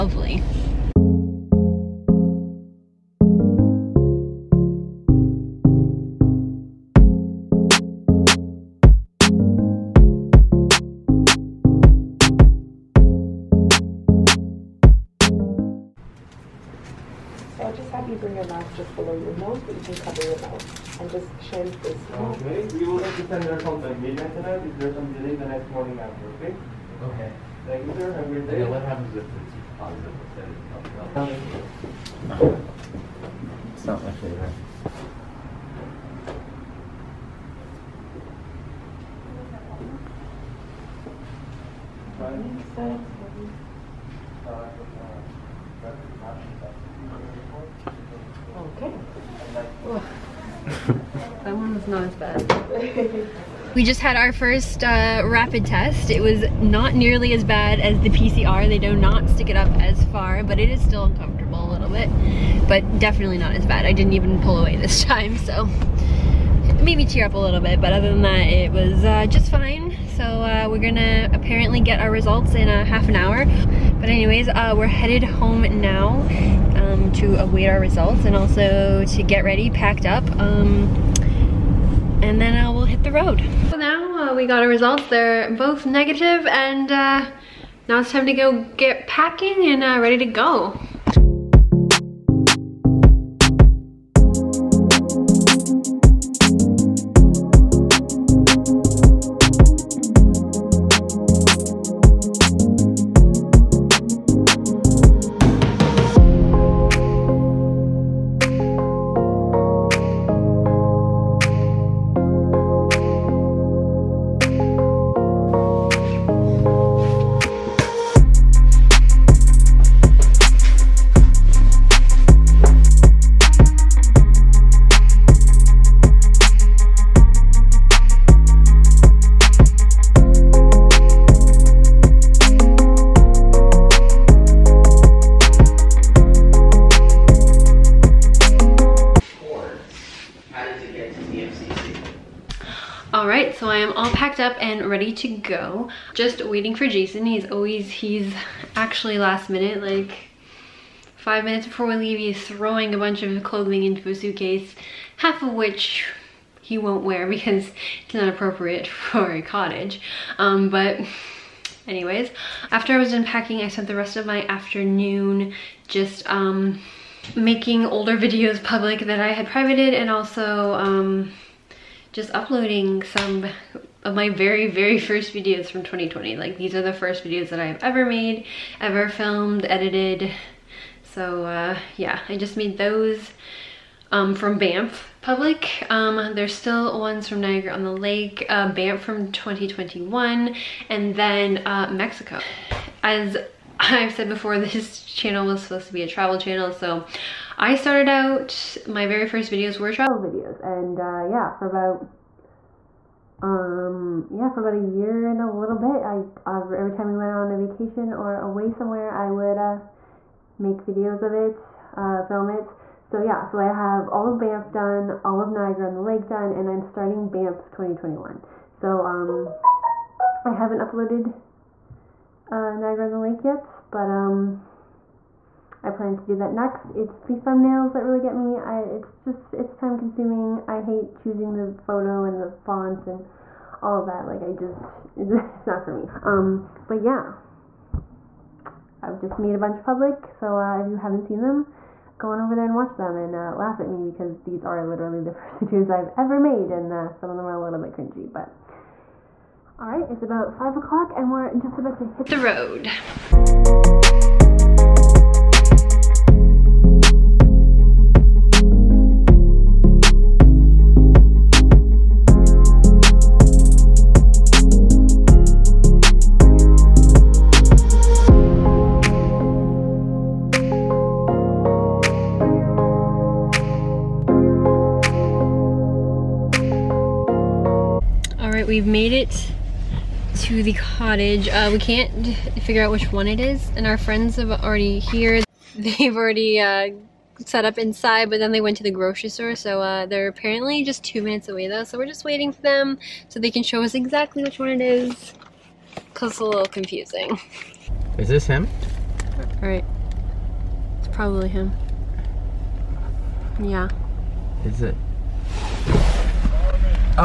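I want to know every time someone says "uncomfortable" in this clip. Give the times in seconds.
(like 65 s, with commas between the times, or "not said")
61 s.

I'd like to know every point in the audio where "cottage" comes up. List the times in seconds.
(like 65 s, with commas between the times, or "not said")
159 s, 280 s.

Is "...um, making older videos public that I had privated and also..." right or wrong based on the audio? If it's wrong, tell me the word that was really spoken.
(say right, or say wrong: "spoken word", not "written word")
right.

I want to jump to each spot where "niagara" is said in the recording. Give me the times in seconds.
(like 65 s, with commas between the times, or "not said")
187 s, 215 s, 222 s.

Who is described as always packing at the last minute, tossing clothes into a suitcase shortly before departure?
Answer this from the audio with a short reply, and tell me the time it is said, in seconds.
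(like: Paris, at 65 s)
Jason, at 146 s.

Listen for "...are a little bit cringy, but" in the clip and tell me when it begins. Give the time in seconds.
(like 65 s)
247 s.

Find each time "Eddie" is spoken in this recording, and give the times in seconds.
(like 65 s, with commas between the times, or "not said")
not said.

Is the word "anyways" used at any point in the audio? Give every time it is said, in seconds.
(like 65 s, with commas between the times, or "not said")
74 s, 161 s.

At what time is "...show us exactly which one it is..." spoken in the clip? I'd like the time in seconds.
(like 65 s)
293 s.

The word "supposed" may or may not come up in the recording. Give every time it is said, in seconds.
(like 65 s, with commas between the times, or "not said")
195 s.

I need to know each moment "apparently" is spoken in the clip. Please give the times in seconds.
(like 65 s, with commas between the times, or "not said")
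71 s, 290 s.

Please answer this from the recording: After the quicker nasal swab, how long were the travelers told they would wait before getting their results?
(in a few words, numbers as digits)
half an hour.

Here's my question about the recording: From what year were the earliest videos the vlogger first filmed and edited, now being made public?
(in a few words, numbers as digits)
2020.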